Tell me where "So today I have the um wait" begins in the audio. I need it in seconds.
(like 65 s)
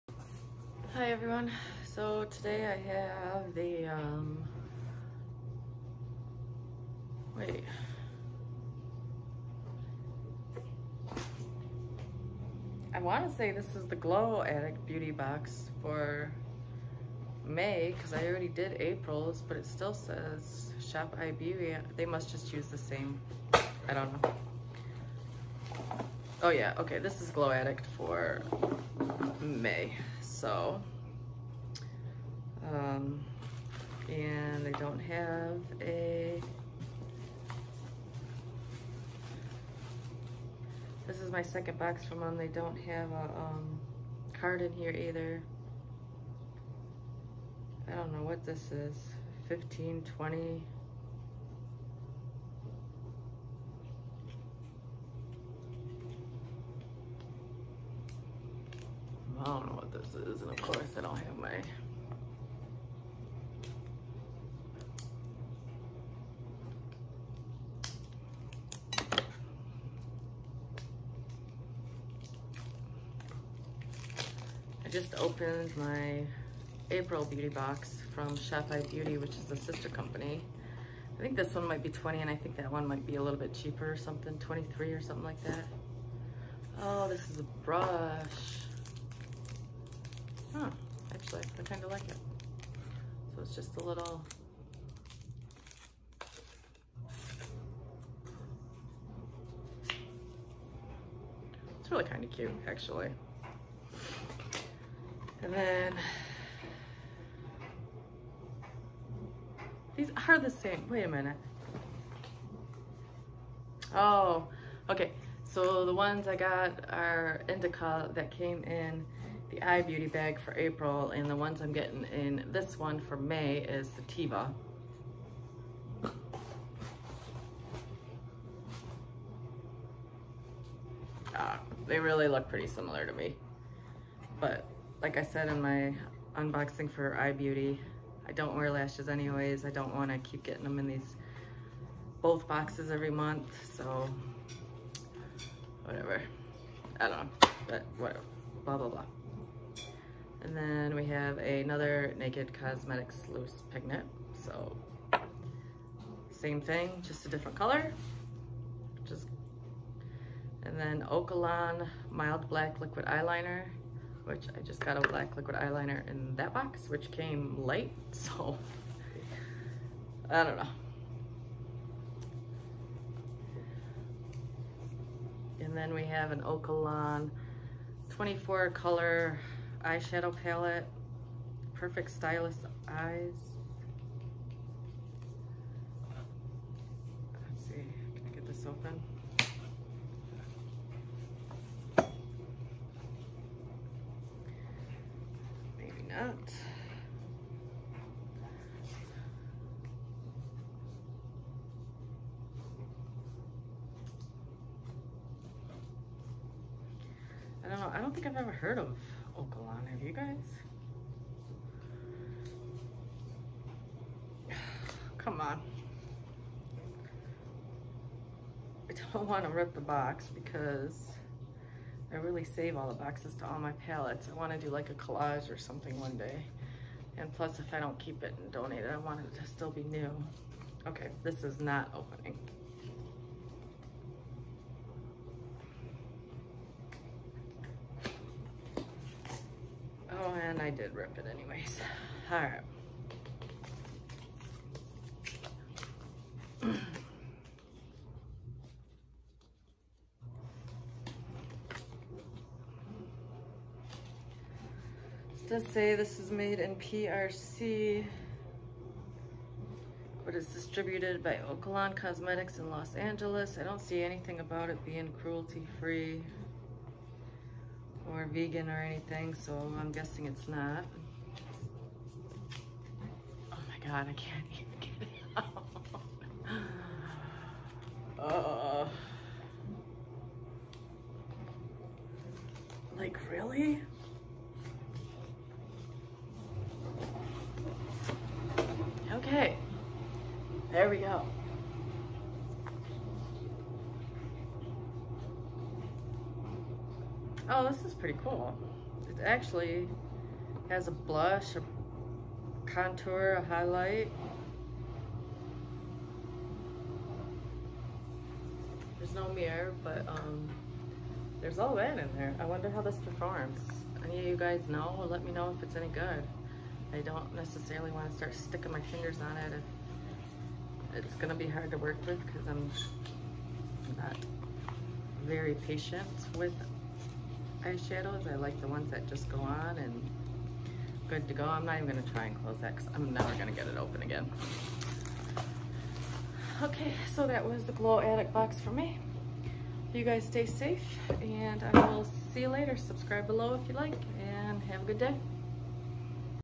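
1 s.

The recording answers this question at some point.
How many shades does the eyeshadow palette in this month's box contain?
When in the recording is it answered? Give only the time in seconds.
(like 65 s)
178 s.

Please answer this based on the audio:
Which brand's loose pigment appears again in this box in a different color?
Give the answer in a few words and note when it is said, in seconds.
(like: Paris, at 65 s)
Naked Cosmetics, at 152 s.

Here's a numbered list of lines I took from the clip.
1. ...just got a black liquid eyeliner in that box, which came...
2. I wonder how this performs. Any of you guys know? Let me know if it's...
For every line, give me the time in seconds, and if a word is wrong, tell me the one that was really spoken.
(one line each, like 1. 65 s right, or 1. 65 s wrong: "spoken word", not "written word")
1. 164 s right
2. 312 s right.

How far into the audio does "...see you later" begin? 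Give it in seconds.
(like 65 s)
342 s.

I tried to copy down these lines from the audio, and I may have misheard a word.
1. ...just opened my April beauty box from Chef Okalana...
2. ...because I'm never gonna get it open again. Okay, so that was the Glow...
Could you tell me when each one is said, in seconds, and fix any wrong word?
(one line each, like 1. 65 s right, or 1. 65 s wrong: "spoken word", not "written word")
1. 74 s wrong: "Eye", not "Okalana"
2. 332 s right.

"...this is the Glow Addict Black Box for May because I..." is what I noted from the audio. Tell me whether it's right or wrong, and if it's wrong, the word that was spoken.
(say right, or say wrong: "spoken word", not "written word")
wrong: "Beauty", not "Black".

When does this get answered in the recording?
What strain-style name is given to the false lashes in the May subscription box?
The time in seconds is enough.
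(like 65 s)
123 s.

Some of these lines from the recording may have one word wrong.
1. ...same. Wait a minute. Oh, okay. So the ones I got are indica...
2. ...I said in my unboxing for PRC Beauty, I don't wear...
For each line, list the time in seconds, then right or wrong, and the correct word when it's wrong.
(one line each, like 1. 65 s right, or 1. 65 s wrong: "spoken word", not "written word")
1. 110 s right
2. 135 s wrong: "Eye", not "PRC".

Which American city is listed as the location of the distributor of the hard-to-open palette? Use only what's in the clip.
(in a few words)
Los Angeles.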